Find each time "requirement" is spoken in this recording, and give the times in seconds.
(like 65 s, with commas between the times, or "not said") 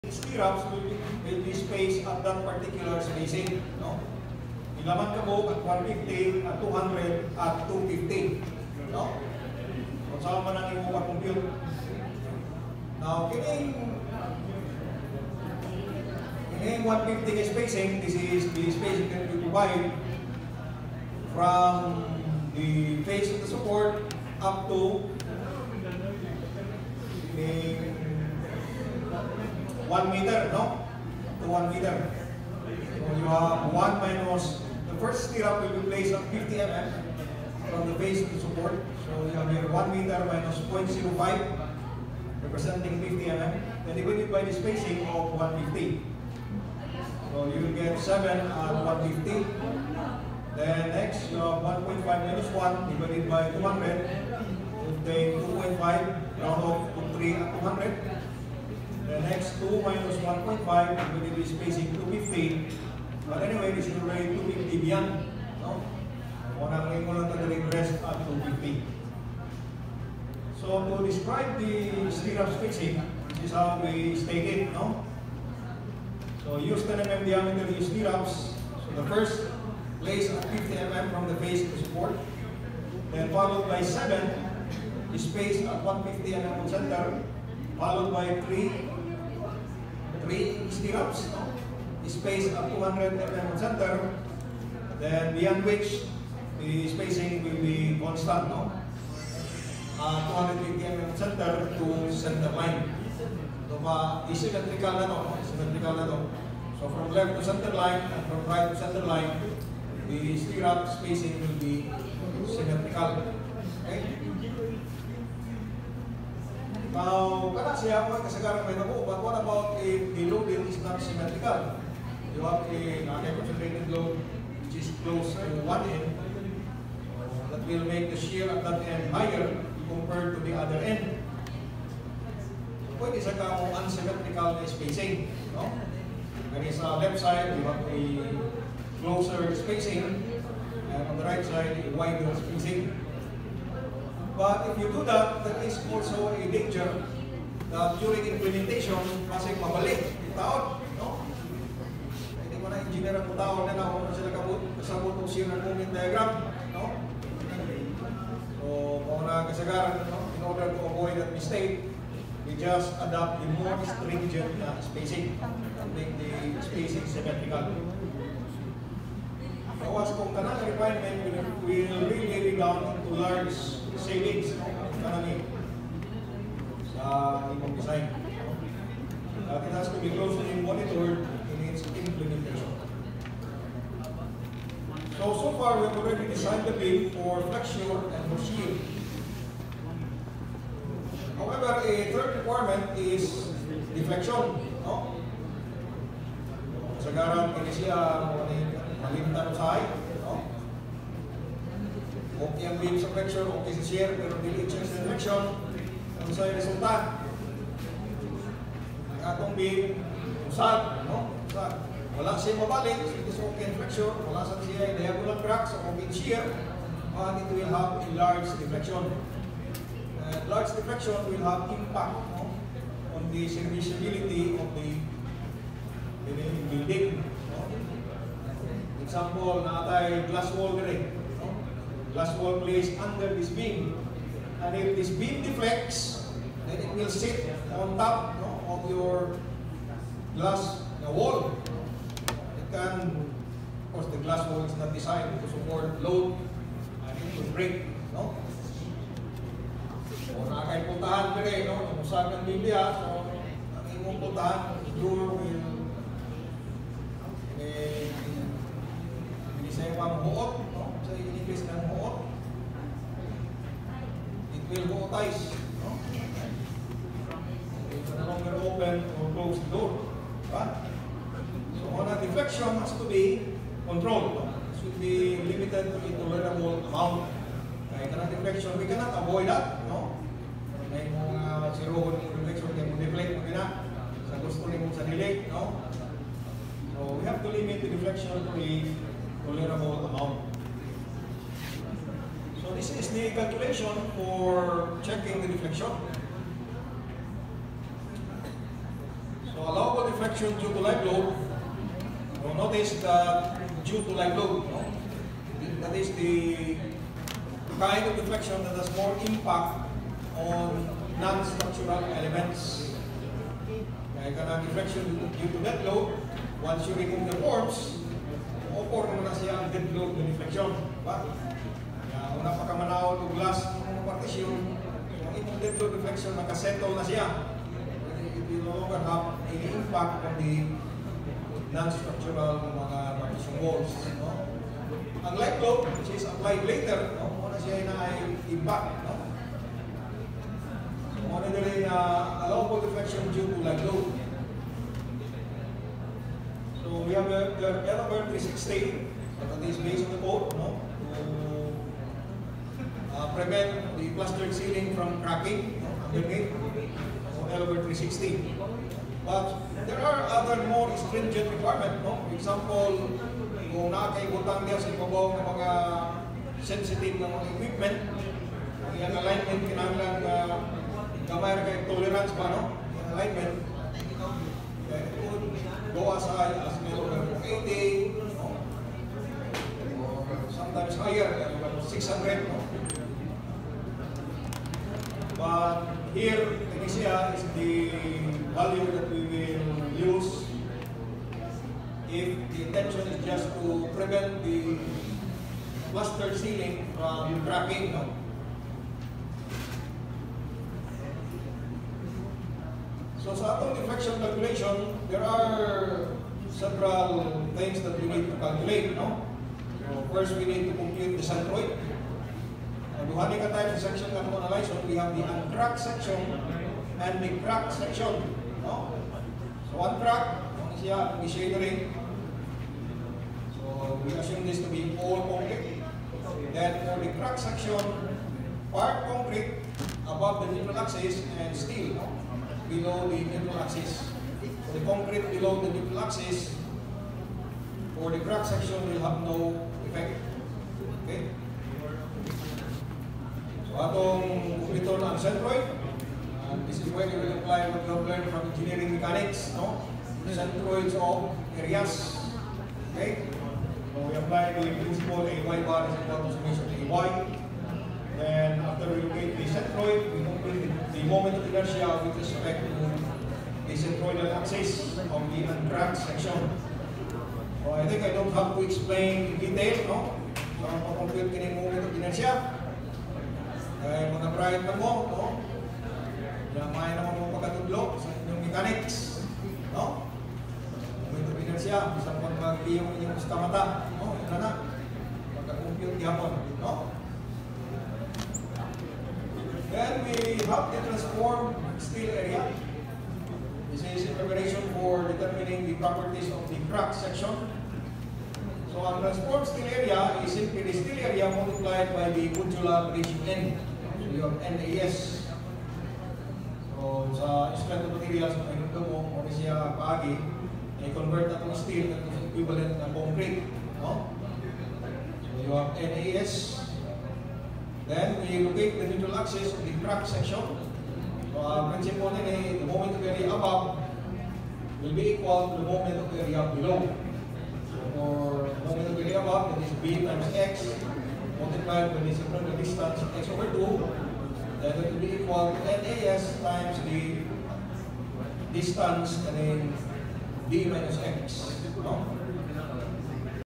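170 s, 192 s, 361 s.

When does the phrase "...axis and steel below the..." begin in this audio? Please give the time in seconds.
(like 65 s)
430 s.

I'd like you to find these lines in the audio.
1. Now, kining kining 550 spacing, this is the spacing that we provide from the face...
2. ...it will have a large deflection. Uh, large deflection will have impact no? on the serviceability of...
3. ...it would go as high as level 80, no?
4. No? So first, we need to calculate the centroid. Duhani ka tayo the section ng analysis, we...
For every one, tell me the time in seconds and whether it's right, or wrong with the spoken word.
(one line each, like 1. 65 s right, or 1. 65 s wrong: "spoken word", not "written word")
1. 13 s wrong: "150", not "550"
2. 217 s right
3. 374 s right
4. 408 s wrong: "compute", not "calculate".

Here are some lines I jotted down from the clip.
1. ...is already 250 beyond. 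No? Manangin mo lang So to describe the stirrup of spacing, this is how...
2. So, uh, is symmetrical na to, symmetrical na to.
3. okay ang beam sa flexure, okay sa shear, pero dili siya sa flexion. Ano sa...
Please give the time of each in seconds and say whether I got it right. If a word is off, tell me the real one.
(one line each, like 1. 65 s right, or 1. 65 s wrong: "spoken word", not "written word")
1. 63 s right
2. 103 s right
3. 202 s right.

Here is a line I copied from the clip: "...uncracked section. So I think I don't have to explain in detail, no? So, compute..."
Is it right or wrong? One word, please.
right.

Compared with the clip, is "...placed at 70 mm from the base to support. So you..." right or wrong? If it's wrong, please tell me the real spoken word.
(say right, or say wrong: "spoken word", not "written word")
wrong: "50", not "70".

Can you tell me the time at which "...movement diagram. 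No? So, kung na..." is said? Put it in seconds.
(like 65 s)
155 s.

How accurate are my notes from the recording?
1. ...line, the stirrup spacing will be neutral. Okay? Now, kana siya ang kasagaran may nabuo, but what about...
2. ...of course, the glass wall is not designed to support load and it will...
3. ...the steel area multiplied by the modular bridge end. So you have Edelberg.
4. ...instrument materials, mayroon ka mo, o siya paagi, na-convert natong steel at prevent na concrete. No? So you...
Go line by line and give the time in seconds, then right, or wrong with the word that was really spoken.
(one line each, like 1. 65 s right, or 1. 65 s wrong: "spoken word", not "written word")
1. 109 s wrong: "symmetrical", not "neutral"
2. 243 s right
3. 500 s wrong: "NAS", not "Edelberg"
4. 507 s wrong: "equivalent", not "prevent".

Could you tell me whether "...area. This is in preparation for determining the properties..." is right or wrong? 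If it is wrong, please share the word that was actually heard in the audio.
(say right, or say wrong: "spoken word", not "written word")
right.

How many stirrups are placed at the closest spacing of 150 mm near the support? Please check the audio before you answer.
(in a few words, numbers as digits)
7.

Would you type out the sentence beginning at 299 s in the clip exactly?
So allowable deflection due to live load, you notice that uh, due to live load, no?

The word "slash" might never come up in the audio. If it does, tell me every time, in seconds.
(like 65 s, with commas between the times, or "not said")
not said.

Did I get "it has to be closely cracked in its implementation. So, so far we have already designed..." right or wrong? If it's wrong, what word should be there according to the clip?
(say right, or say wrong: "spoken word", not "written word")
wrong: "monitored", not "cracked".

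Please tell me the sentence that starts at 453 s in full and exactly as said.
So we apply the principle AY bar is equal to summation AY.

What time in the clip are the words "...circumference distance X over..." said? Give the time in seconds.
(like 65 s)
532 s.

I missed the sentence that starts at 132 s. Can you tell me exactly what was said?
Pwede sa kamo unsymmetrical na spacing.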